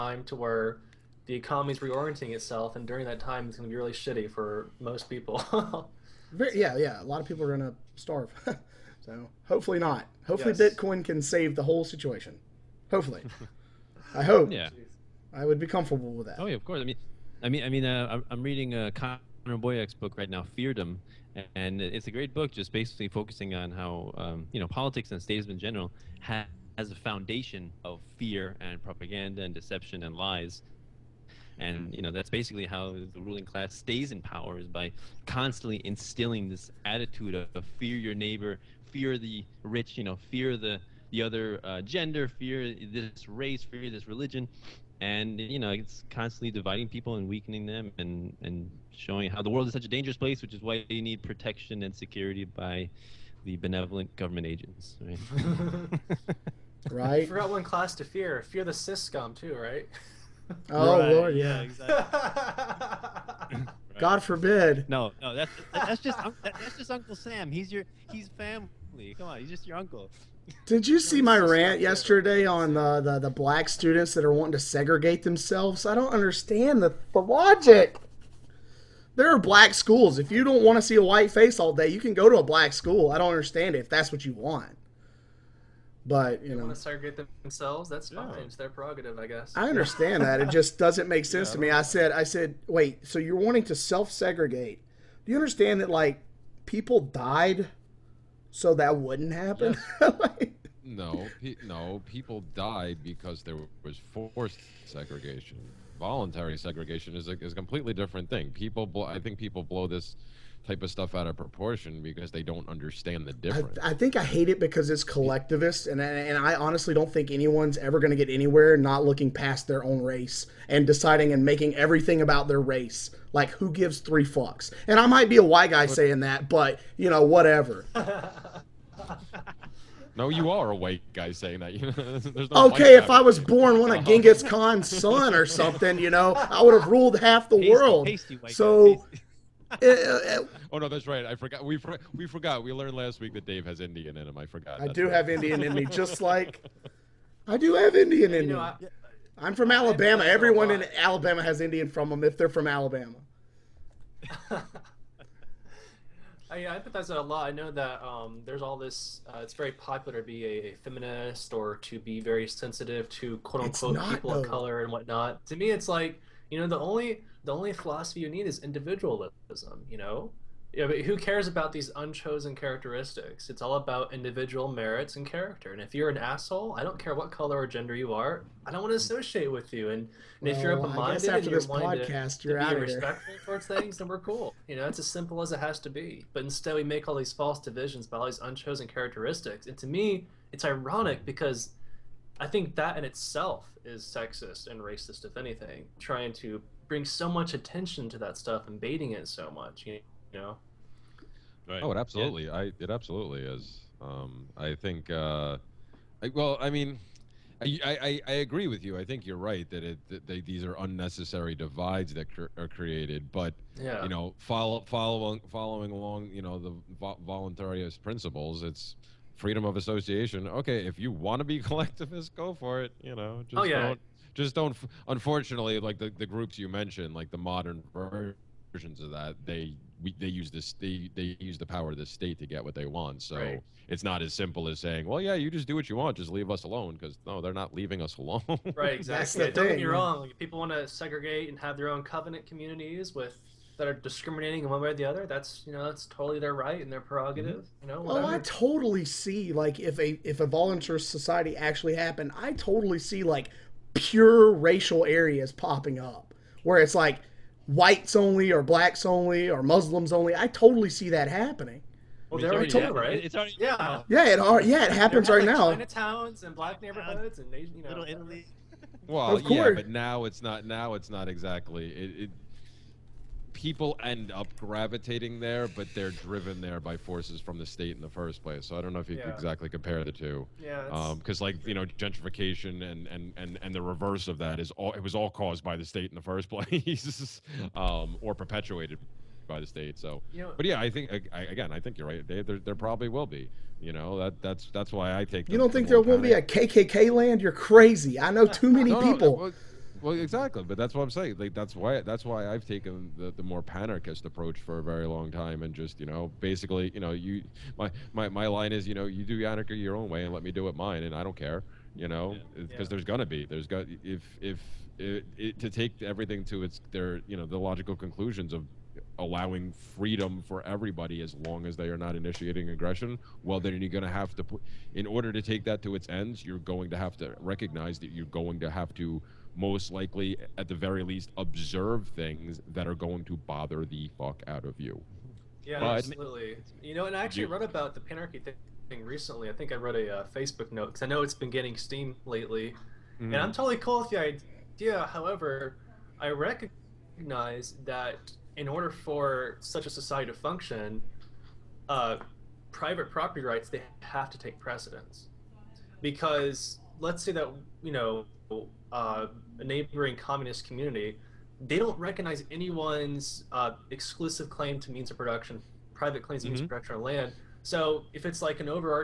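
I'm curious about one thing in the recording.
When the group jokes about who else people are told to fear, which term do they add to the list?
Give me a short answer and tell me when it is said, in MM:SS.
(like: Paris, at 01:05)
syscom, at 00:58.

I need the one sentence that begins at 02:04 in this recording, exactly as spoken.
And I might be a white guy saying that, but you know, whatever.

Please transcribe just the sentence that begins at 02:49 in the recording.
You know, yeah, but who cares about these unchosen characteristics?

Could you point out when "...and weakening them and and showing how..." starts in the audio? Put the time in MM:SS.
00:47.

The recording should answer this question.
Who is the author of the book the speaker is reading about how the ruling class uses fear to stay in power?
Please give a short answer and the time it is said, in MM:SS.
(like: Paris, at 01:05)
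Connor Boyack, at 00:18.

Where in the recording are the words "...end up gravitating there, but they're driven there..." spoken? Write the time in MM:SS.
04:34.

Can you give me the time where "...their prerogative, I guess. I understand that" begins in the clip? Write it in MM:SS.
01:28.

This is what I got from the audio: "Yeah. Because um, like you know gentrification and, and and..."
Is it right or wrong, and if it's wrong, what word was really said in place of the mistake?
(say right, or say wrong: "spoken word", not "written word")
right.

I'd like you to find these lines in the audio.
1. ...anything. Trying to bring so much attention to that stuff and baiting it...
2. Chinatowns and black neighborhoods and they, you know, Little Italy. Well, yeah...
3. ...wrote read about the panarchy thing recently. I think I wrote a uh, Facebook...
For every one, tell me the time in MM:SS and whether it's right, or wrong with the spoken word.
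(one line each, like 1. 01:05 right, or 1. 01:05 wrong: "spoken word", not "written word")
1. 03:15 right
2. 04:25 right
3. 05:37 right.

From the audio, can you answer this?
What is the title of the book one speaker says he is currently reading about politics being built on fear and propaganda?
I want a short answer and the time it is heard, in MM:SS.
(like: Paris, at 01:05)
Feardom, at 00:20.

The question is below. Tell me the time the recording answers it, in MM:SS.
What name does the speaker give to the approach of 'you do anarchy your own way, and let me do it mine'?
05:03.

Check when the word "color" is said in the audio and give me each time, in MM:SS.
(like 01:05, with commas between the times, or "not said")
02:44, 02:57.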